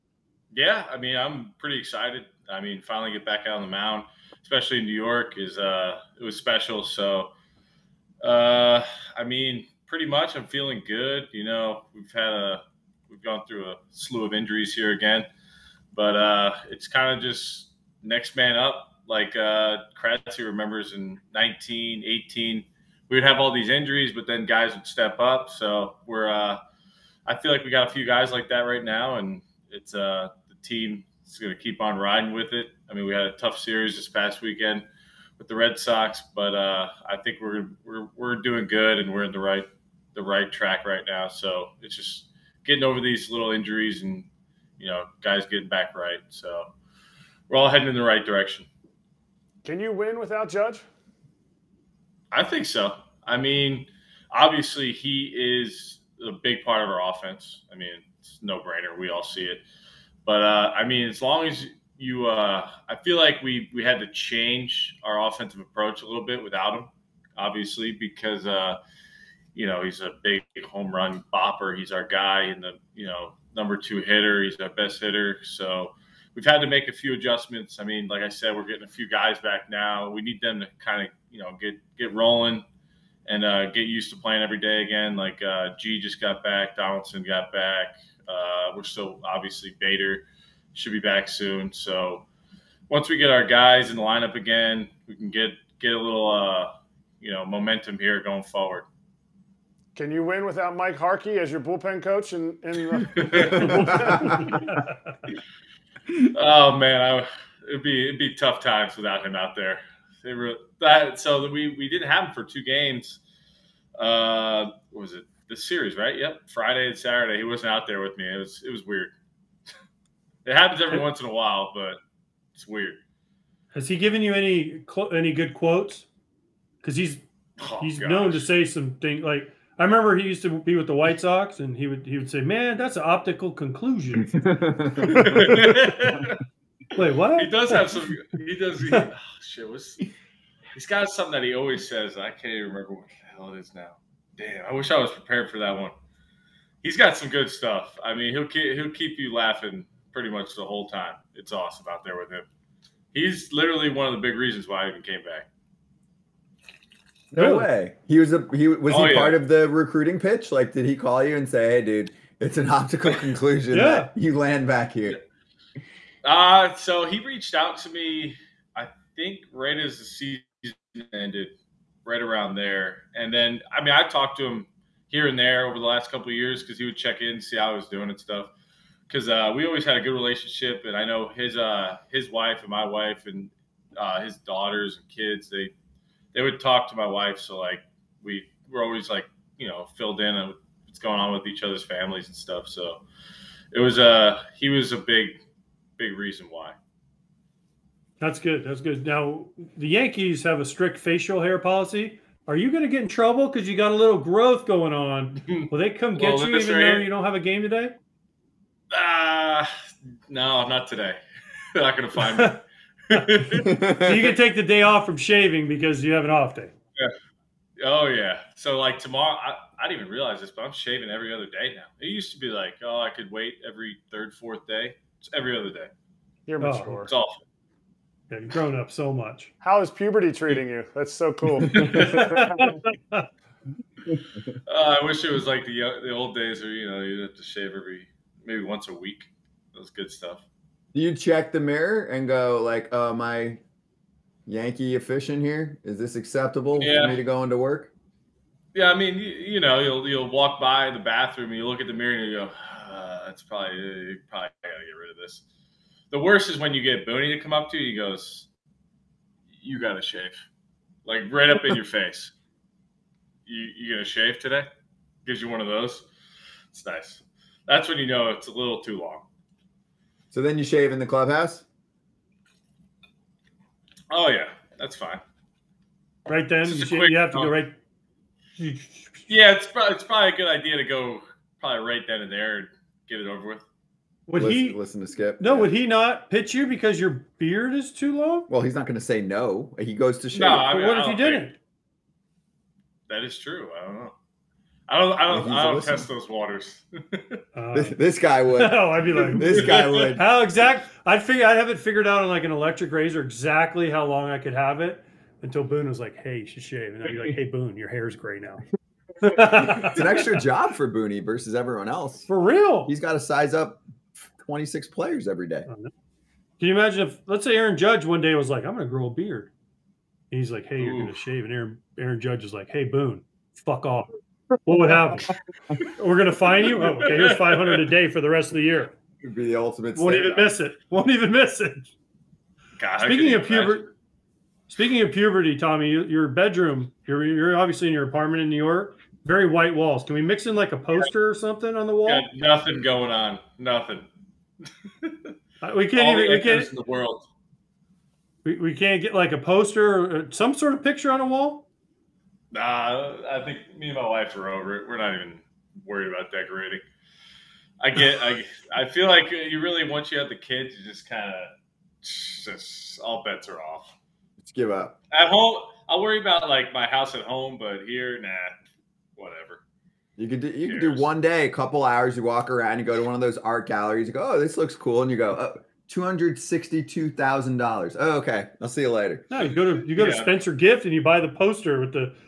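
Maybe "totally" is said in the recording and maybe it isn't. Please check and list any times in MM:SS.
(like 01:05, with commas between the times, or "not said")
not said.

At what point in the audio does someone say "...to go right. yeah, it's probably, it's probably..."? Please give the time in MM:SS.
04:37.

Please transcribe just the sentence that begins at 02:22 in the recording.
I can't even remember what the hell it is now.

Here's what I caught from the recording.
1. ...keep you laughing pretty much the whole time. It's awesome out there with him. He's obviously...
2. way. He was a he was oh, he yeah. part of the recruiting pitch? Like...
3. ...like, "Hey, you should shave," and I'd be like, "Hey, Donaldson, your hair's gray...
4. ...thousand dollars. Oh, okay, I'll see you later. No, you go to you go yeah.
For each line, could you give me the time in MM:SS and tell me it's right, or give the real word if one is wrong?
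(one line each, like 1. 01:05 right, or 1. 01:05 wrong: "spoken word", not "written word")
1. 02:28 wrong: "literally", not "obviously"
2. 02:37 right
3. 05:05 wrong: "Boone", not "Donaldson"
4. 06:17 right.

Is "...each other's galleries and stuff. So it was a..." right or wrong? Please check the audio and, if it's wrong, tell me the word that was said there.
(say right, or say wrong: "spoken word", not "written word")
wrong: "families", not "galleries".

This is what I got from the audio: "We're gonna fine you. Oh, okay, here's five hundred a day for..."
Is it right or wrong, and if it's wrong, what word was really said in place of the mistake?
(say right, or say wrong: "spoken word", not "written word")
right.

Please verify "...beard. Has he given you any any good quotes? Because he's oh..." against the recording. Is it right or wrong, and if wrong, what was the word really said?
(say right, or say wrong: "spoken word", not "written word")
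wrong: "weird", not "beard".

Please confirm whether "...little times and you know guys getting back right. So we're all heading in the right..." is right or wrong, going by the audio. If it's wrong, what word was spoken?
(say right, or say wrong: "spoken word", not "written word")
wrong: "injuries", not "times".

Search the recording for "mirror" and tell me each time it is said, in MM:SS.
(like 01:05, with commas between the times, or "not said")
04:01, 04:11.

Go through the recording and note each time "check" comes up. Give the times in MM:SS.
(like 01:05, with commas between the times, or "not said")
02:56, 04:01.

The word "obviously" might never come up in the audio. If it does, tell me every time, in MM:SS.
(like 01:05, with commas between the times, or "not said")
00:54, 01:07, 01:29, 05:37.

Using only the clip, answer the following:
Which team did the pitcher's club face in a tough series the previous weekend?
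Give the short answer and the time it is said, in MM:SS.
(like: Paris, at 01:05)
Red Sox, at 00:35.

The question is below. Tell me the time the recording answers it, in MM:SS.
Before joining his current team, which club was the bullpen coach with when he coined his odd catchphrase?
02:10.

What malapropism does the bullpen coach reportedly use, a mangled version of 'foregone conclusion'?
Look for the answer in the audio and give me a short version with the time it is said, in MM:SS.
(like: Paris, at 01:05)
optical conclusion, at 02:13.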